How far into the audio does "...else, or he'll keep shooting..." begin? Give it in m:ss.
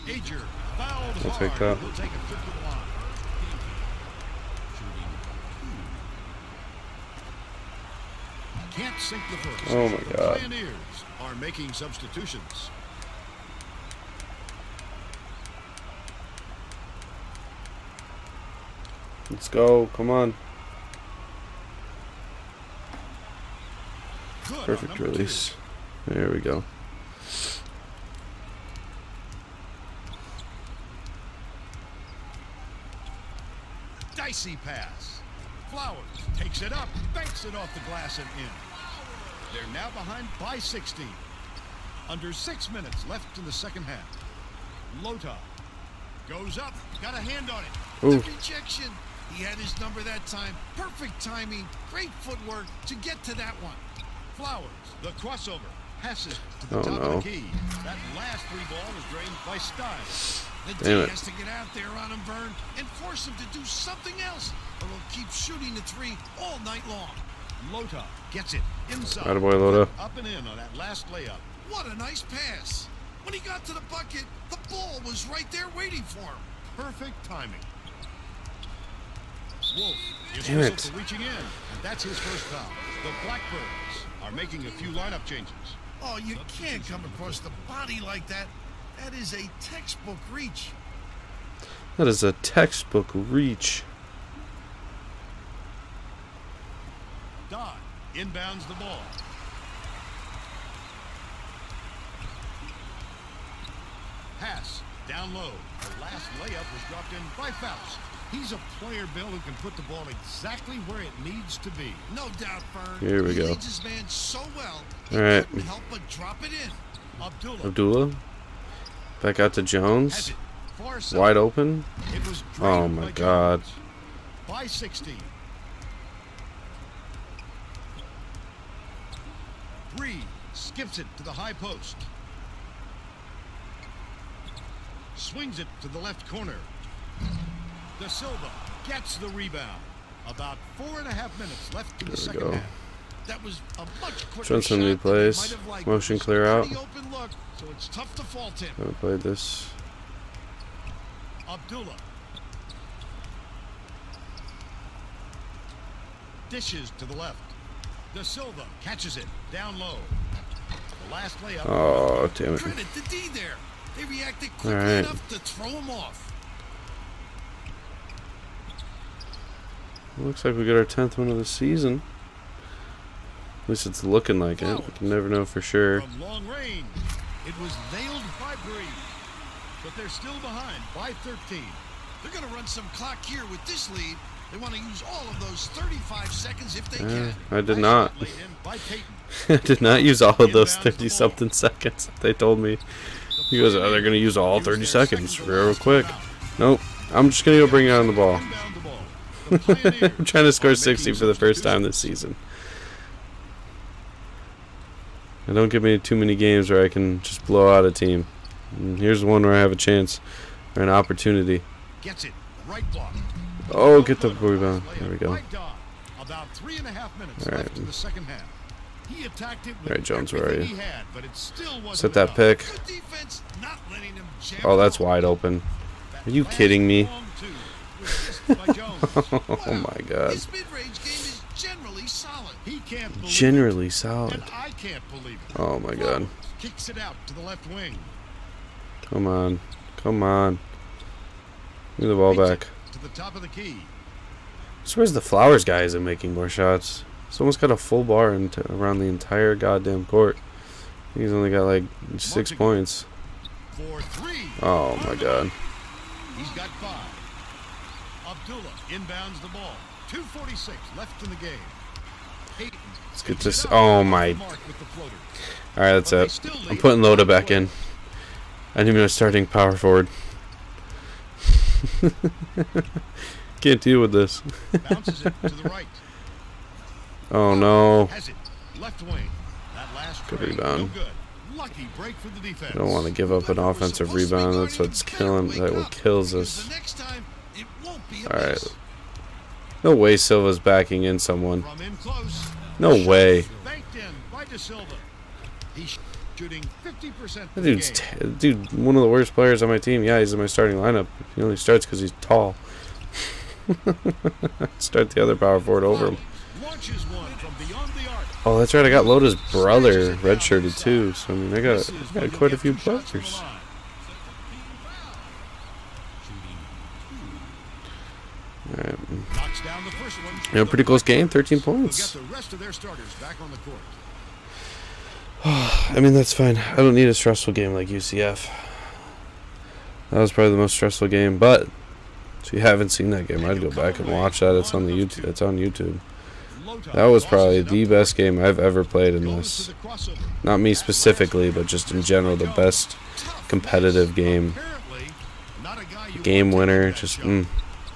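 1:04.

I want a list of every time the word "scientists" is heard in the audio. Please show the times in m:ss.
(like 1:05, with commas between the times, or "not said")
not said.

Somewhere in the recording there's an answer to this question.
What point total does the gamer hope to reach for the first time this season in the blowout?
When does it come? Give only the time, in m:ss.
3:20.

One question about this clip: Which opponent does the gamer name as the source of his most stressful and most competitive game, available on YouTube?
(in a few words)
UCF.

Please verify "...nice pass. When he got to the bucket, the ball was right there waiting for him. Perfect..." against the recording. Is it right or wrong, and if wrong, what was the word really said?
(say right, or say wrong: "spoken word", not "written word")
right.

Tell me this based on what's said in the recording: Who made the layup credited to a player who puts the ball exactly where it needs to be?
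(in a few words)
Faust.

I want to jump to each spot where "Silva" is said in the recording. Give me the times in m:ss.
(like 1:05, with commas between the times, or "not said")
2:18, 2:38, 4:50.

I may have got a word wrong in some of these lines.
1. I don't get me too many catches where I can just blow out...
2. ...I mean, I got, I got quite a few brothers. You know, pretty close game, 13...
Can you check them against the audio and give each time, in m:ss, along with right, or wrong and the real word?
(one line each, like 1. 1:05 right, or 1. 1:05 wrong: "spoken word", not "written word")
1. 3:25 wrong: "games", not "catches"
2. 5:11 right.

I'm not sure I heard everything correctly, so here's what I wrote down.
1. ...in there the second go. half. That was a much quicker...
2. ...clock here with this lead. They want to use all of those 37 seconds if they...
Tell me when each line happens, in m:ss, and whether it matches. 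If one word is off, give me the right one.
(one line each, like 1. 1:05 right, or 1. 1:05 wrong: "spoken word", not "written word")
1. 2:22 right
2. 3:02 wrong: "35", not "37".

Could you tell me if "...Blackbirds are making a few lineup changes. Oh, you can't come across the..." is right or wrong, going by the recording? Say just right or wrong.
right.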